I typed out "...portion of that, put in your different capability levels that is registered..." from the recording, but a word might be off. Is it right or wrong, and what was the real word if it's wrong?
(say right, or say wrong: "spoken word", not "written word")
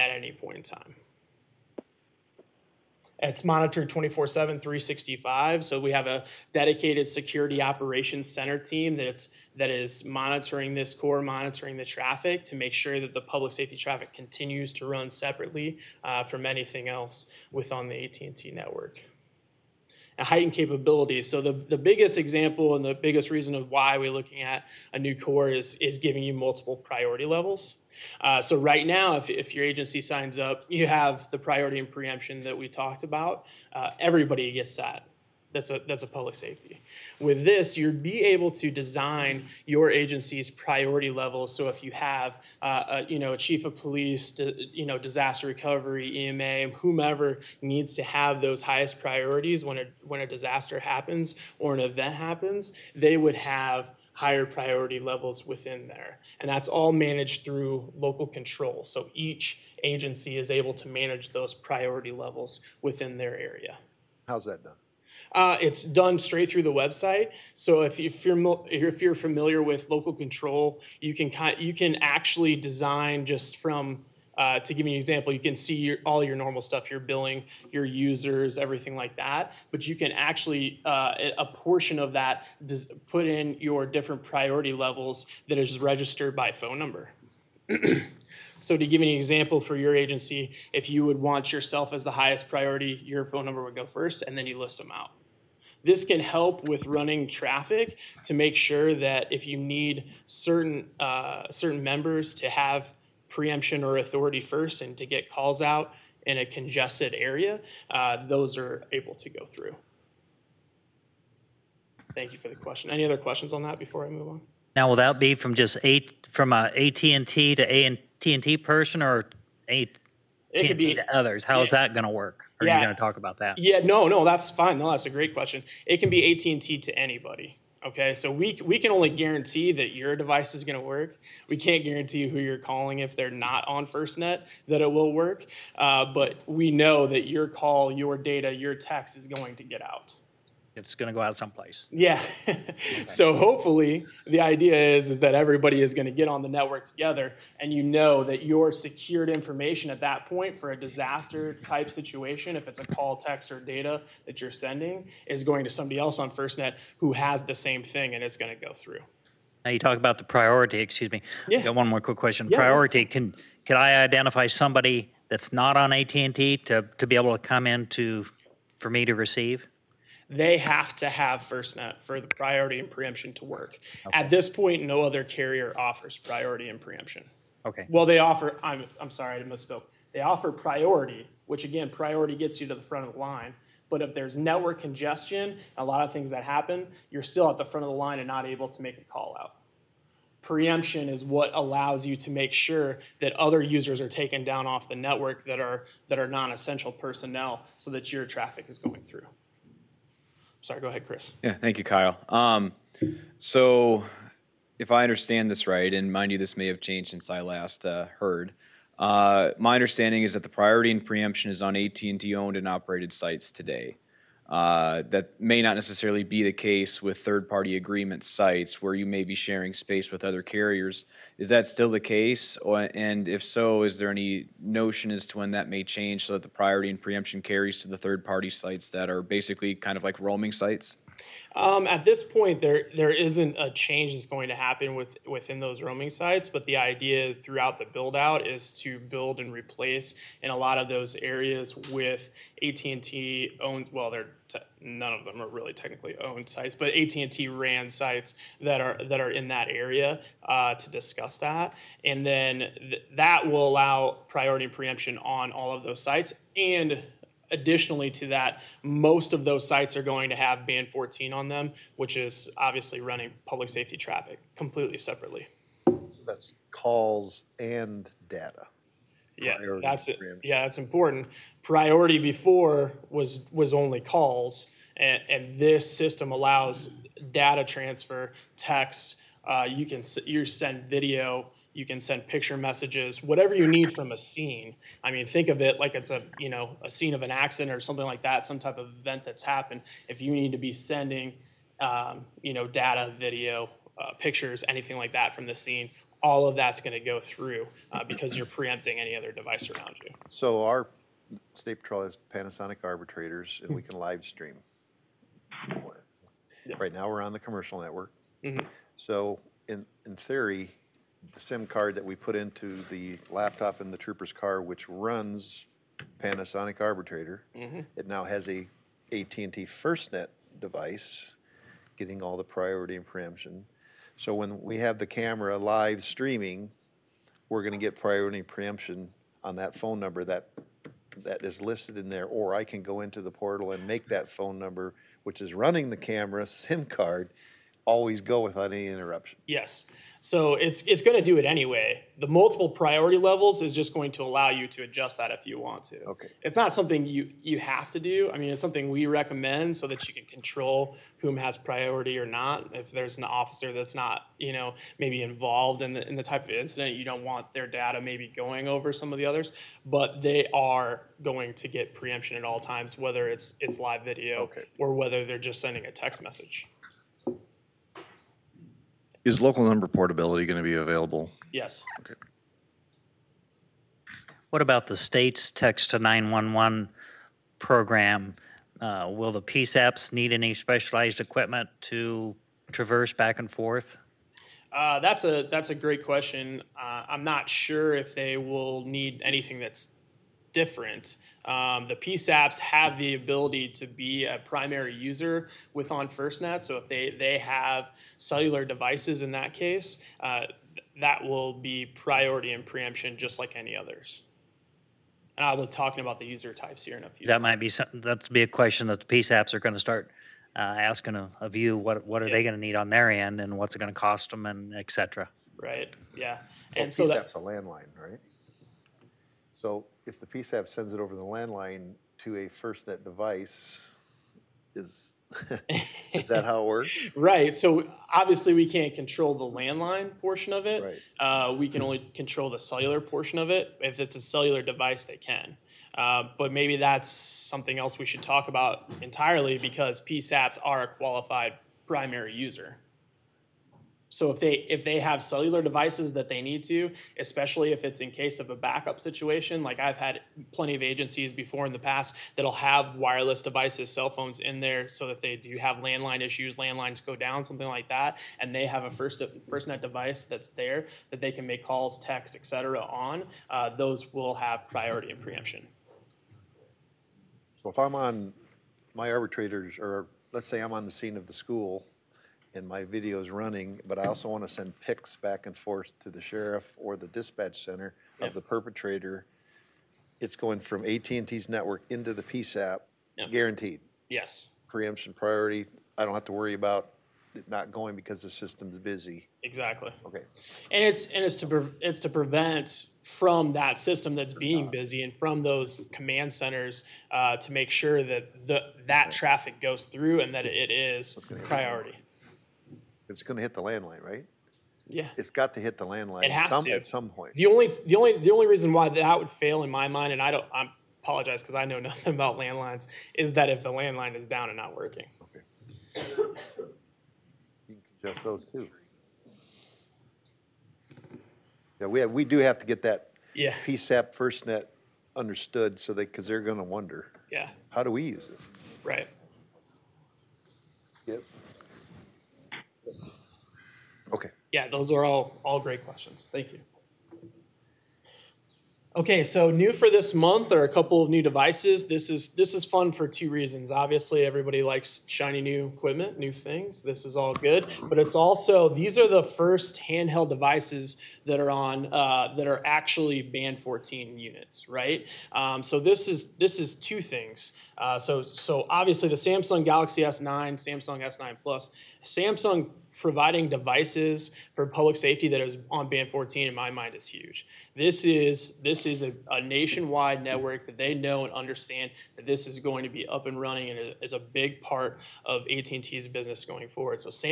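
wrong: "priority", not "capability".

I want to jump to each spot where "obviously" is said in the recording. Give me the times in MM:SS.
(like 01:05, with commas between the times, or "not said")
04:22, 07:08, 09:03, 09:18.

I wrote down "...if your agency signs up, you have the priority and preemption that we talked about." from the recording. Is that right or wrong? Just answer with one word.
right.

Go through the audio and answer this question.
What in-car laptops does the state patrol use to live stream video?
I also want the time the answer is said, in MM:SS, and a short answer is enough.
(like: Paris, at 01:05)
Panasonic Arbitrator, at 05:02.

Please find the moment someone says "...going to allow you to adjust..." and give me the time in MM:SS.
05:43.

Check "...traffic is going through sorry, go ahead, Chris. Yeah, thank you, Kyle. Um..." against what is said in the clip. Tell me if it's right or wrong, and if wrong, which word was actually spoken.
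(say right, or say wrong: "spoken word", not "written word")
right.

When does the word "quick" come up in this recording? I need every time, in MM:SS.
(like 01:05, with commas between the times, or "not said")
02:42.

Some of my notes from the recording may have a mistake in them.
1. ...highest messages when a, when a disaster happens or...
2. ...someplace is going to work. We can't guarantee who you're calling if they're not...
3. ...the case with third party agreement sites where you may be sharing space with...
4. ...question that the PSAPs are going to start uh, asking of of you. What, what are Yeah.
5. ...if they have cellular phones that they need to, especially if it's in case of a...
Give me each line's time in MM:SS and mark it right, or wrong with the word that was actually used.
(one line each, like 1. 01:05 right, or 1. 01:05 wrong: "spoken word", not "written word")
1. 00:48 wrong: "priorities", not "messages"
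2. 02:10 wrong: "device", not "someplace"
3. 03:36 right
4. 06:48 right
5. 07:24 wrong: "devices", not "phones".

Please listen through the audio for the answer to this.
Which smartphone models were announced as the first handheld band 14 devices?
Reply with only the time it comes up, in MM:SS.
09:19.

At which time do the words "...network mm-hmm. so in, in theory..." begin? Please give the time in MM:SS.
05:07.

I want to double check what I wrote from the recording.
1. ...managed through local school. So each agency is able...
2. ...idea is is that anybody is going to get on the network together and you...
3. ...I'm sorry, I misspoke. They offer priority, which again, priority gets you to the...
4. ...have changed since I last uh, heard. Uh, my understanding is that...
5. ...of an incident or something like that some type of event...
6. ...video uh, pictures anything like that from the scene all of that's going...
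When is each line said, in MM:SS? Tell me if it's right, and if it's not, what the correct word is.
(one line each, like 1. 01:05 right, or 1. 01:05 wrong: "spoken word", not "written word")
1. 00:56 wrong: "control", not "school"
2. 02:24 wrong: "everybody", not "anybody"
3. 02:59 right
4. 03:26 right
5. 04:47 wrong: "accident", not "incident"
6. 04:53 right.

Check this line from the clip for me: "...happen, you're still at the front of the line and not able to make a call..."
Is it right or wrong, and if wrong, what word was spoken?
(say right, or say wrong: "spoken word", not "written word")
right.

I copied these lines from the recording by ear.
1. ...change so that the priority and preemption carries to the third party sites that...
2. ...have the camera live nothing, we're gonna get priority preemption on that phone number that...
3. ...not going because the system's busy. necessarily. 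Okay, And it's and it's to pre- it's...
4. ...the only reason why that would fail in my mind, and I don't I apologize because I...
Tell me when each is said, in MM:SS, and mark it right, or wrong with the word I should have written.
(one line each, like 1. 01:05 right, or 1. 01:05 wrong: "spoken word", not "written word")
1. 03:45 right
2. 05:24 wrong: "streaming", not "nothing"
3. 08:07 wrong: "exactly", not "necessarily"
4. 08:28 right.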